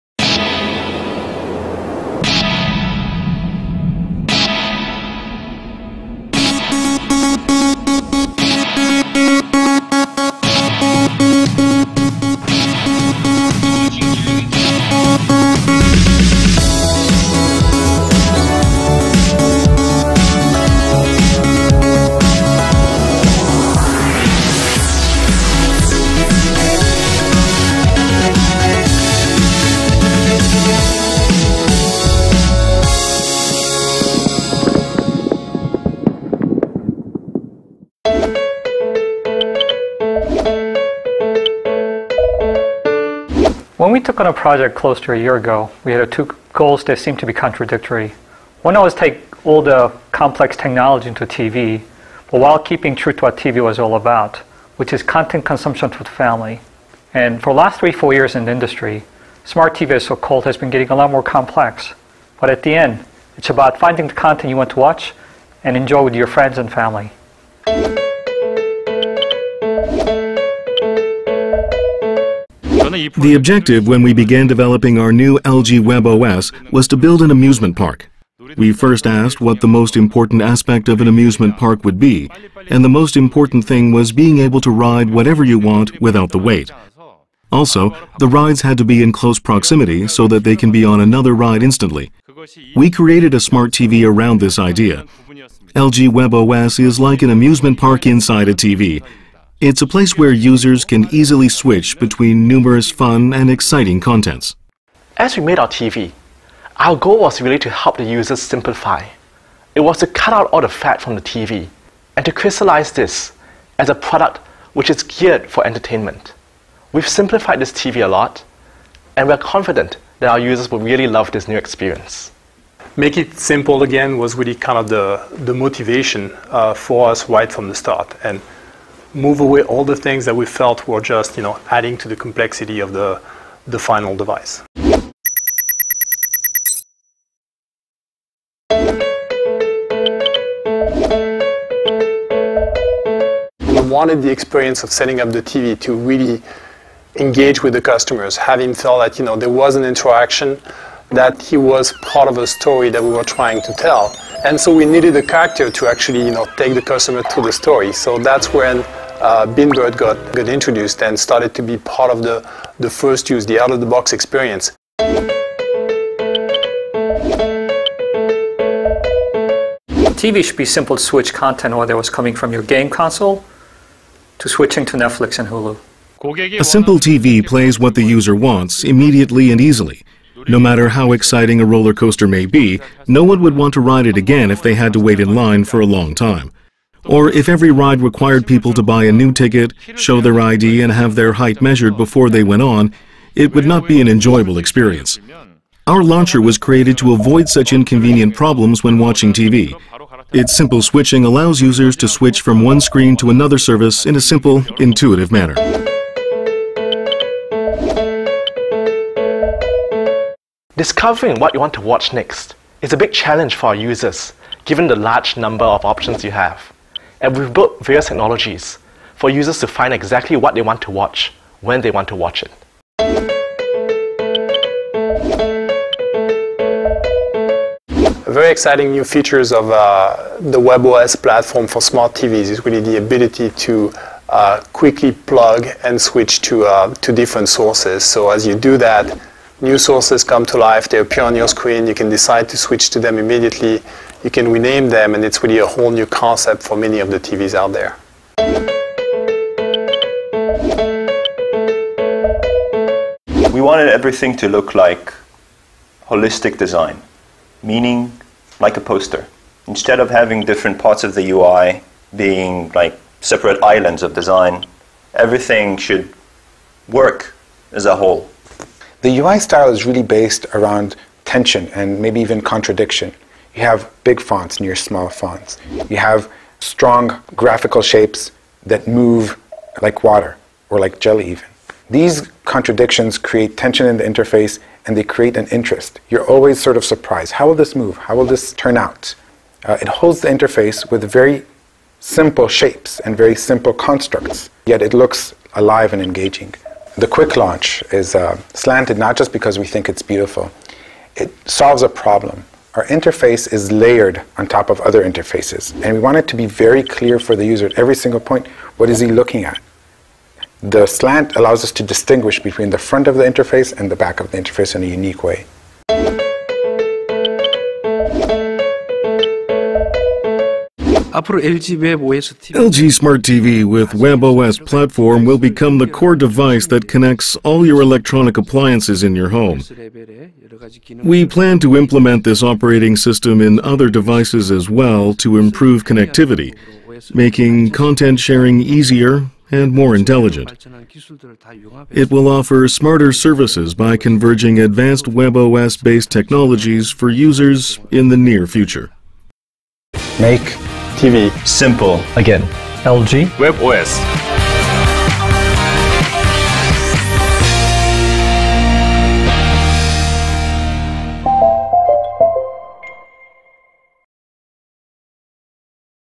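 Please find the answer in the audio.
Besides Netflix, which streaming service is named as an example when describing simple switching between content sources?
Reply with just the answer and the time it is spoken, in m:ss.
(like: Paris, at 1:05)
Hulu, at 2:55.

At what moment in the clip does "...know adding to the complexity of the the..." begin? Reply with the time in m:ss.
2:11.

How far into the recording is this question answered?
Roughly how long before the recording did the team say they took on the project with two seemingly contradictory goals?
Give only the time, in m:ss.
0:44.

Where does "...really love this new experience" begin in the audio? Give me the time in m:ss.
2:00.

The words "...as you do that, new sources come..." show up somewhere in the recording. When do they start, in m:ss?
3:58.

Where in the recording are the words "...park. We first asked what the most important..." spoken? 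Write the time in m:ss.
1:17.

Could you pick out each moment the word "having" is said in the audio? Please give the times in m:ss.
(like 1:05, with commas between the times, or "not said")
2:28, 4:20.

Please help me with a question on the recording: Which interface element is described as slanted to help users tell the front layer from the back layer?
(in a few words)
quick launch.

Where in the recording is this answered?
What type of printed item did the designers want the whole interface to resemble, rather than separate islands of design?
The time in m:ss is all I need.
4:18.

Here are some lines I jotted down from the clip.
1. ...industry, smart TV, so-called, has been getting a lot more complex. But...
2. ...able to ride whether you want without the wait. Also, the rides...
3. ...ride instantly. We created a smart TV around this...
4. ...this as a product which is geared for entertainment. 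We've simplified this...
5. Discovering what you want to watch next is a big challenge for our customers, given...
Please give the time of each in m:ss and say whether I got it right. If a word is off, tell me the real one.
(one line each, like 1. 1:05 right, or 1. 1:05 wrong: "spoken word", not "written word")
1. 0:58 right
2. 1:24 wrong: "whatever", not "whether"
3. 1:31 right
4. 1:52 right
5. 3:30 wrong: "users", not "customers".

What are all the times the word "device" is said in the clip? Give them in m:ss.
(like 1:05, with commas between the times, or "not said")
2:14, 5:26, 5:33.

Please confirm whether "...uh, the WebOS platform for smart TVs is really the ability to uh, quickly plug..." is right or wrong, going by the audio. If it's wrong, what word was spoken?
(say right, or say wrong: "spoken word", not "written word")
right.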